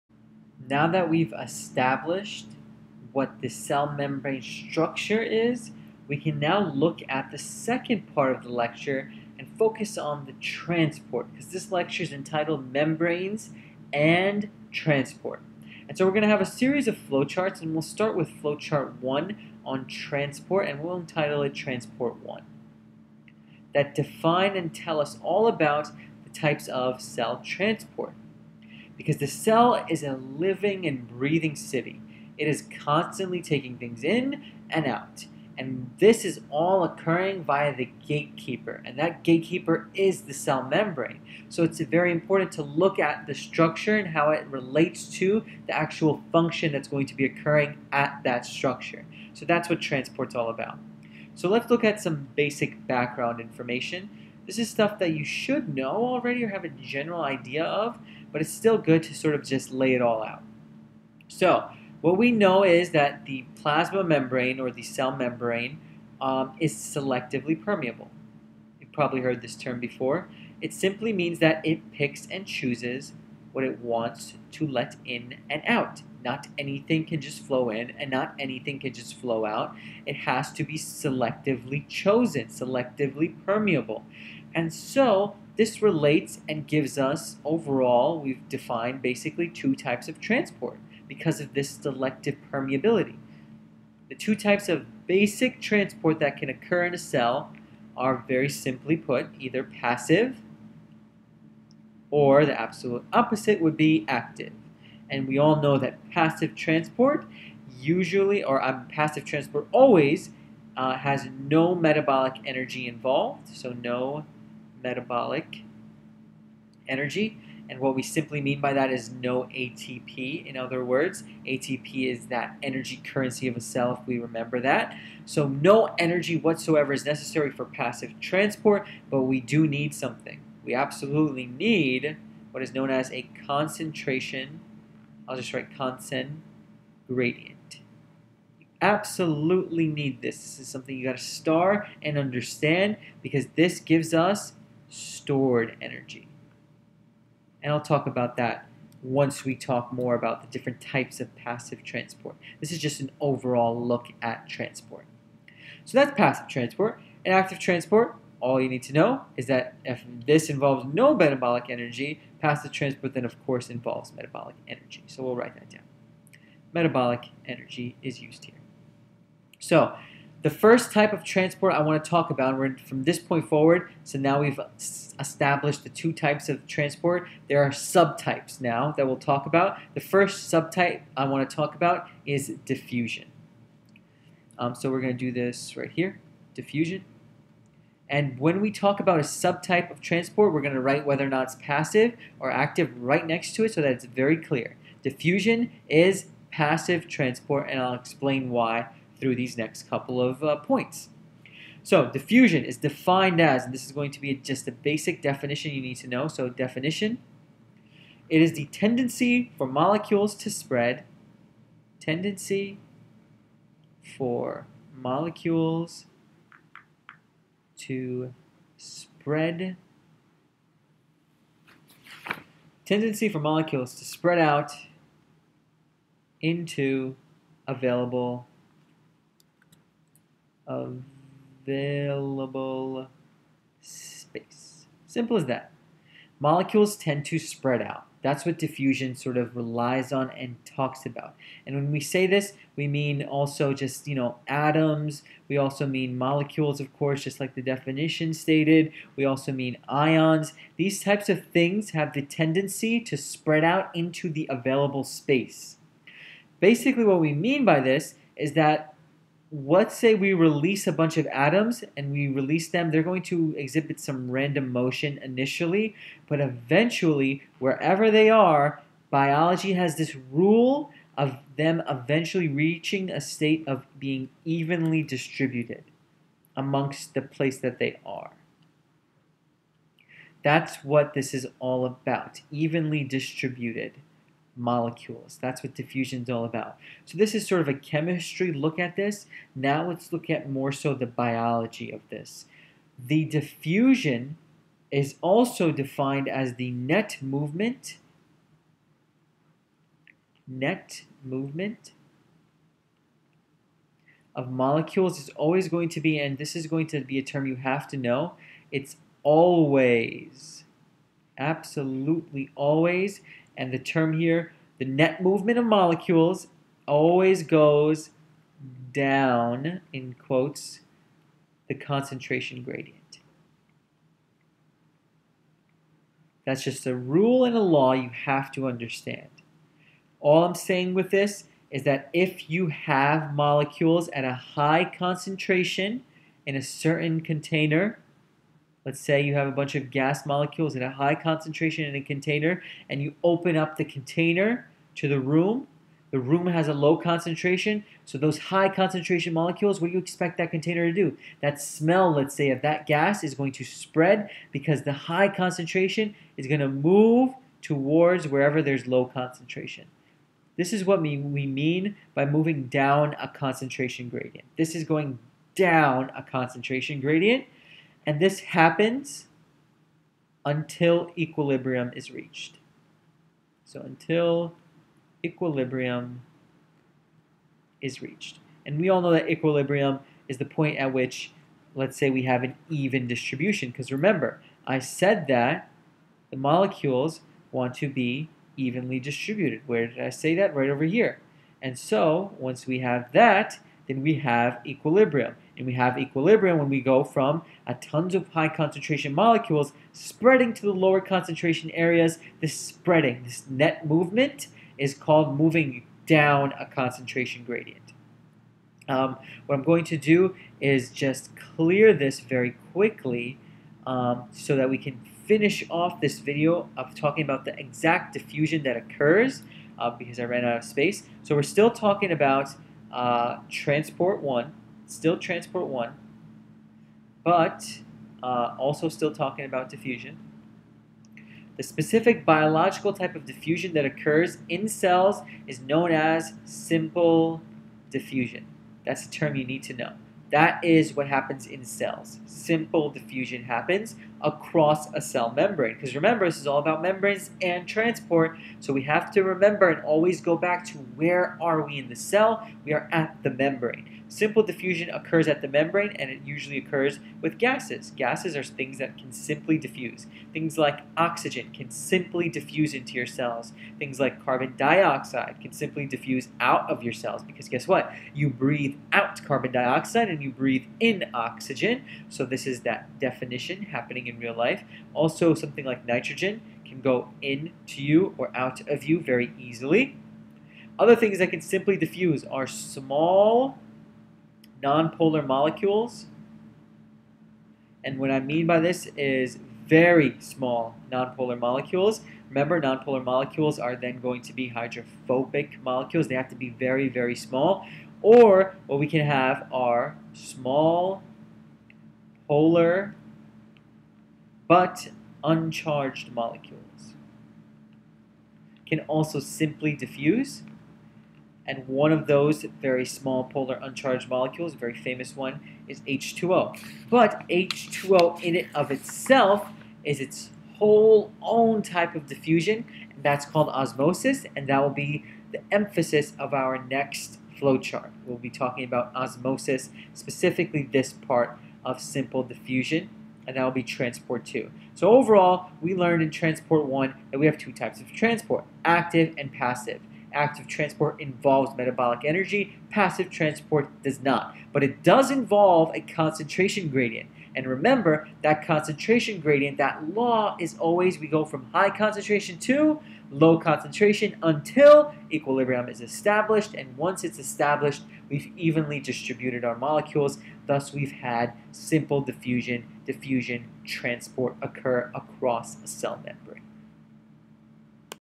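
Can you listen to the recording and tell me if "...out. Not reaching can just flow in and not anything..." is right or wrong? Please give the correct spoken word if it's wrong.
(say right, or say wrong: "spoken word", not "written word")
wrong: "anything", not "reaching".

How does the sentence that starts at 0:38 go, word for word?
And that gatekeeper is the cell membrane.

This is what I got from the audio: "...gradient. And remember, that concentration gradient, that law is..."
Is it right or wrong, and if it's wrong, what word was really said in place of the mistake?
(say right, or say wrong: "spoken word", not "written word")
right.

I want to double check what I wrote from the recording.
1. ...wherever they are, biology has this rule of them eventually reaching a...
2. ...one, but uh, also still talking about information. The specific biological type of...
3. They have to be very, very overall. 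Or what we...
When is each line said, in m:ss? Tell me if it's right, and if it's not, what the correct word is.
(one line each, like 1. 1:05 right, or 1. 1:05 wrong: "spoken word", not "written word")
1. 4:27 right
2. 7:05 wrong: "diffusion", not "information"
3. 8:16 wrong: "small", not "overall".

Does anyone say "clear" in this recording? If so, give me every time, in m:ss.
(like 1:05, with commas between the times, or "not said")
3:14, 6:51.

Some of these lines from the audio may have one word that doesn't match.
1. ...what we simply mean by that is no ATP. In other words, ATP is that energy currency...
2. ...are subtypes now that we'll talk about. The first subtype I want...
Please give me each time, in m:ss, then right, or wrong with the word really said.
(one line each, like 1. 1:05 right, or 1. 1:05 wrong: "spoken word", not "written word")
1. 1:57 right
2. 2:57 right.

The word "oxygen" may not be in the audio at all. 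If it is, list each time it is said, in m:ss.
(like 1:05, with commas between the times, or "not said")
7:40, 7:51.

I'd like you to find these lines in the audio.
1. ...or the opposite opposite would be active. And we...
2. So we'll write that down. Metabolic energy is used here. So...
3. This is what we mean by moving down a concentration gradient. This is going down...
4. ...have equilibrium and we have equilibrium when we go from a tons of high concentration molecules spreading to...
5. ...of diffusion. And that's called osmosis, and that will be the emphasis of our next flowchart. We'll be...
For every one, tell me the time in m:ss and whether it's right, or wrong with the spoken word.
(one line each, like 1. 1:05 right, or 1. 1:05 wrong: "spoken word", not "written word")
1. 1:42 wrong: "absolute", not "opposite"
2. 2:45 right
3. 6:00 right
4. 6:34 right
5. 8:41 right.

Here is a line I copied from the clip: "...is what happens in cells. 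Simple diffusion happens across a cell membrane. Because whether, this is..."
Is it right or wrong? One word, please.
wrong.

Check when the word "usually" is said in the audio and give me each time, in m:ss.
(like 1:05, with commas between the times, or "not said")
1:47, 7:36.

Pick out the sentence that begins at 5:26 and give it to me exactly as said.
That's just a rule and a law you have to understand.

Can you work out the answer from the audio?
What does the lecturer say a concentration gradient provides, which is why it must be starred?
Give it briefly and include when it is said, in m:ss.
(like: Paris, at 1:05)
stored energy, at 2:24.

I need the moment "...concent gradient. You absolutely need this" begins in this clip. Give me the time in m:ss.
2:15.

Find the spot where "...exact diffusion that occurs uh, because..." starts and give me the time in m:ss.
6:57.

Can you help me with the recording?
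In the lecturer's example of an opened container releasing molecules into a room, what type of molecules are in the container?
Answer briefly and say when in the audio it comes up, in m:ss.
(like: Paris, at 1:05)
gas molecules, at 5:39.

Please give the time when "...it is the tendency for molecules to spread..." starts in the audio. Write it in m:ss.
3:28.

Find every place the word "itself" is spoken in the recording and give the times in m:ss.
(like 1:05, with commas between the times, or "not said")
8:38.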